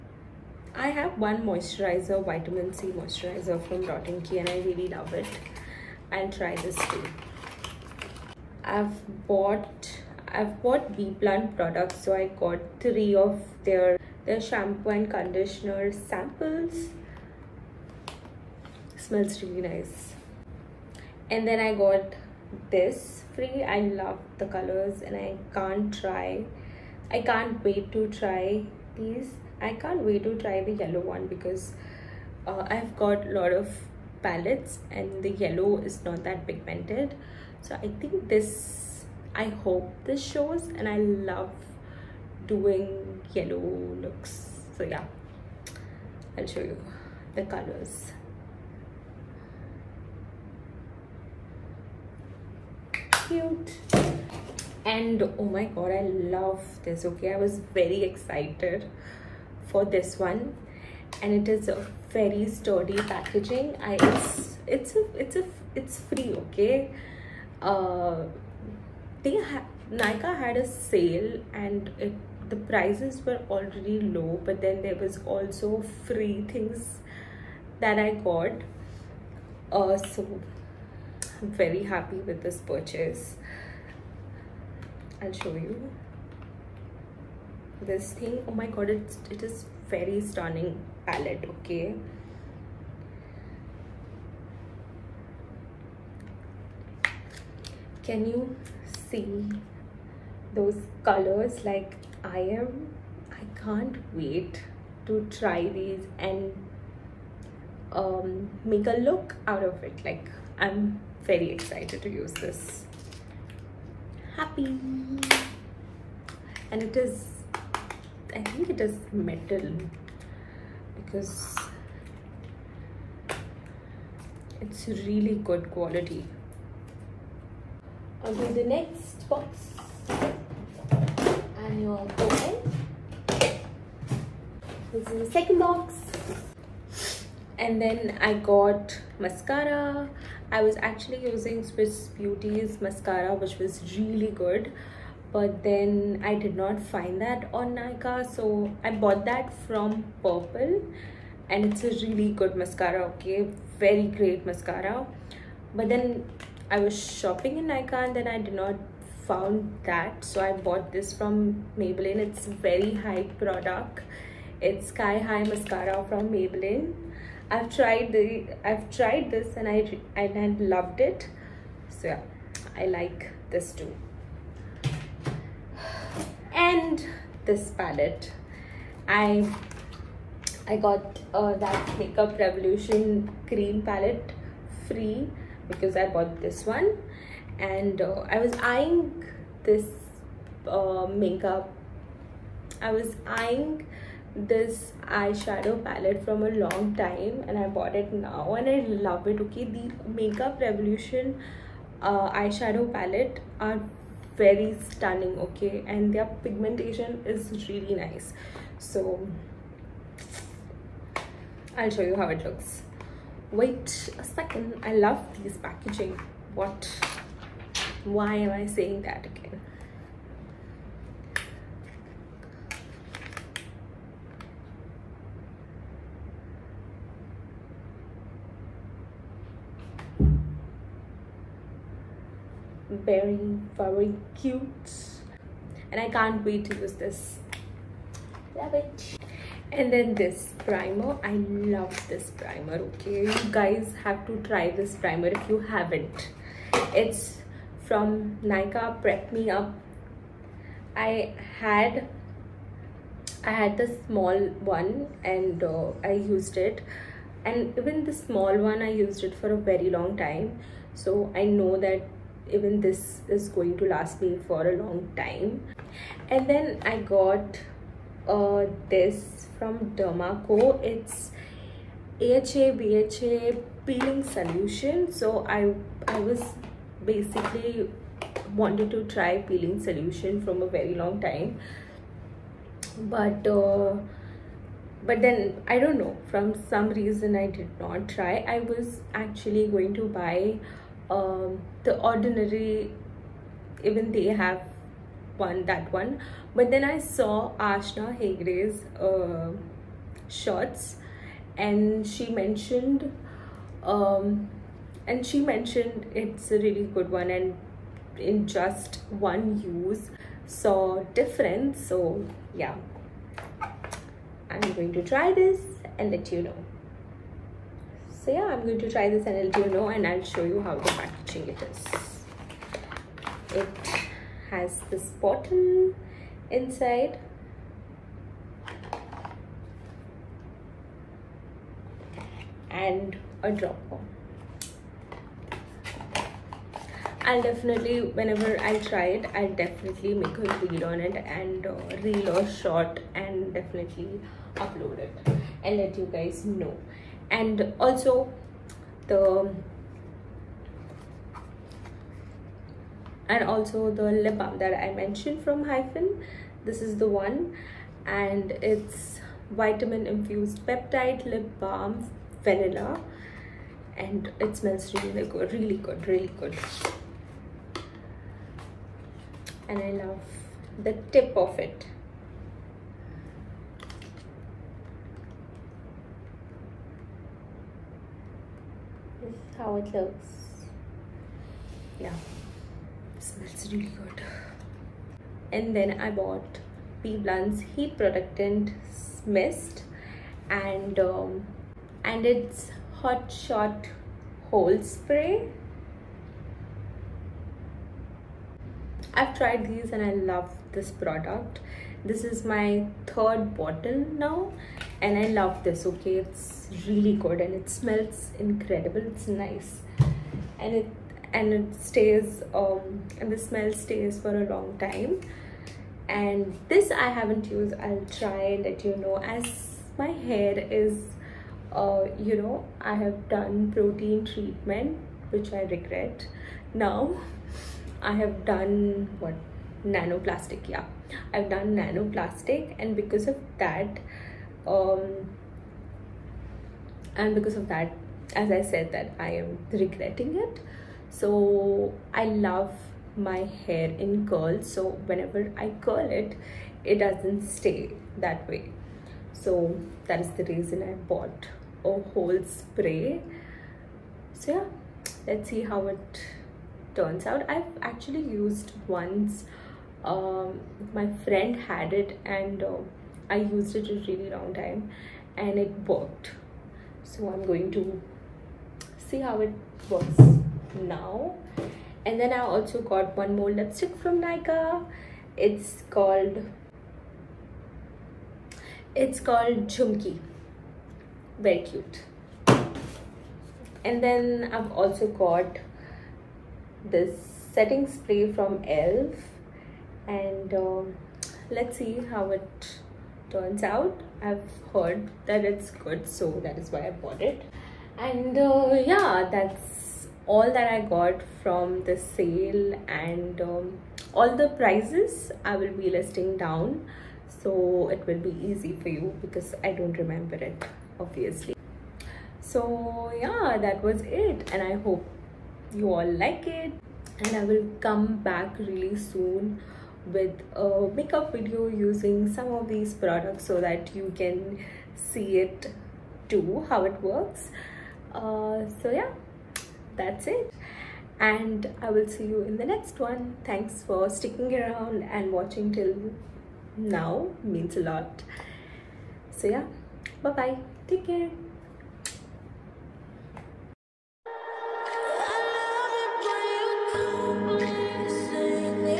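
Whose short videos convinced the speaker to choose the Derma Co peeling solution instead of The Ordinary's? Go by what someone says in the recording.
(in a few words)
Aashna Hegde.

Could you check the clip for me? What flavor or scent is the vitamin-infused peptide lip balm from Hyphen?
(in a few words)
Vanilla.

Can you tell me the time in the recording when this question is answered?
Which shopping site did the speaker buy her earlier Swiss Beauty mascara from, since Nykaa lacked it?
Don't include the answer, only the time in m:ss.
2:30.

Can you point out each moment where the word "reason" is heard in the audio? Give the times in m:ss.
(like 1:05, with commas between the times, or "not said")
4:46, 7:30.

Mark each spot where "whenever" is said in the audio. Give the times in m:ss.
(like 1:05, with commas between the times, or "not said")
5:38, 7:25.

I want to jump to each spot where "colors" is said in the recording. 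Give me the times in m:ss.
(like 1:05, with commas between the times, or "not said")
0:24, 0:47, 1:41.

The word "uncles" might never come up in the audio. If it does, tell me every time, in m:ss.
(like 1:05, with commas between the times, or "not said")
not said.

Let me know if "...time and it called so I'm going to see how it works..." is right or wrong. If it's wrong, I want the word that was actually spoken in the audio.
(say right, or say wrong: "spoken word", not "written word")
wrong: "worked", not "called".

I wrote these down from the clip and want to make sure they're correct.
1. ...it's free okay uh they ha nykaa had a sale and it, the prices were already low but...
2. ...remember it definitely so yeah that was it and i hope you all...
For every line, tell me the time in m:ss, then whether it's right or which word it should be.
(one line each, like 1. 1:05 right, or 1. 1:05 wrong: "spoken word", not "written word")
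1. 1:05 right
2. 8:30 wrong: "obviously", not "definitely".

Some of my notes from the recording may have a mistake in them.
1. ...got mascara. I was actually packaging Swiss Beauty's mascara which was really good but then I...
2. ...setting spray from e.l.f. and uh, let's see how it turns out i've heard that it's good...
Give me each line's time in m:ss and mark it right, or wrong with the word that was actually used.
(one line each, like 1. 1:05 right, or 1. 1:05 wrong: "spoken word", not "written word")
1. 2:18 wrong: "using", not "packaging"
2. 8:07 right.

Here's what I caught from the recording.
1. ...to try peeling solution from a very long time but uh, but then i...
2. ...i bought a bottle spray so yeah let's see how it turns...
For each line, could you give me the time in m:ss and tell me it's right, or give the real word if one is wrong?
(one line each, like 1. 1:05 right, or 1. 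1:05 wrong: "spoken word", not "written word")
1. 4:38 right
2. 7:30 wrong: "whole", not "bottle".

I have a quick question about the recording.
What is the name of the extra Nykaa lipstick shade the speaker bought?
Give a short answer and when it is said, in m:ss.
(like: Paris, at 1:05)
Jhumki, at 7:59.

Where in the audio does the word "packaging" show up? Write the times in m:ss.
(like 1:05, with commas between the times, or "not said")
1:03, 3:35, 5:20.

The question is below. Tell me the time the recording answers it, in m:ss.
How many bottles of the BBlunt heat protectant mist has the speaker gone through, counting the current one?
6:43.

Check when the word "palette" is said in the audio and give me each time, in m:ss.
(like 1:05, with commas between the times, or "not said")
0:34, 1:31, 2:57, 3:03, 3:15, 3:22.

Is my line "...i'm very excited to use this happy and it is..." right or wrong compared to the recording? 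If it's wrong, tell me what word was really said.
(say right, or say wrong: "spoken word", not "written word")
right.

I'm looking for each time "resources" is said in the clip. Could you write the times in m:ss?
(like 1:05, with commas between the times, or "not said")
not said.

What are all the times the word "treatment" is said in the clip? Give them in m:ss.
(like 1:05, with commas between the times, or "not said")
7:04.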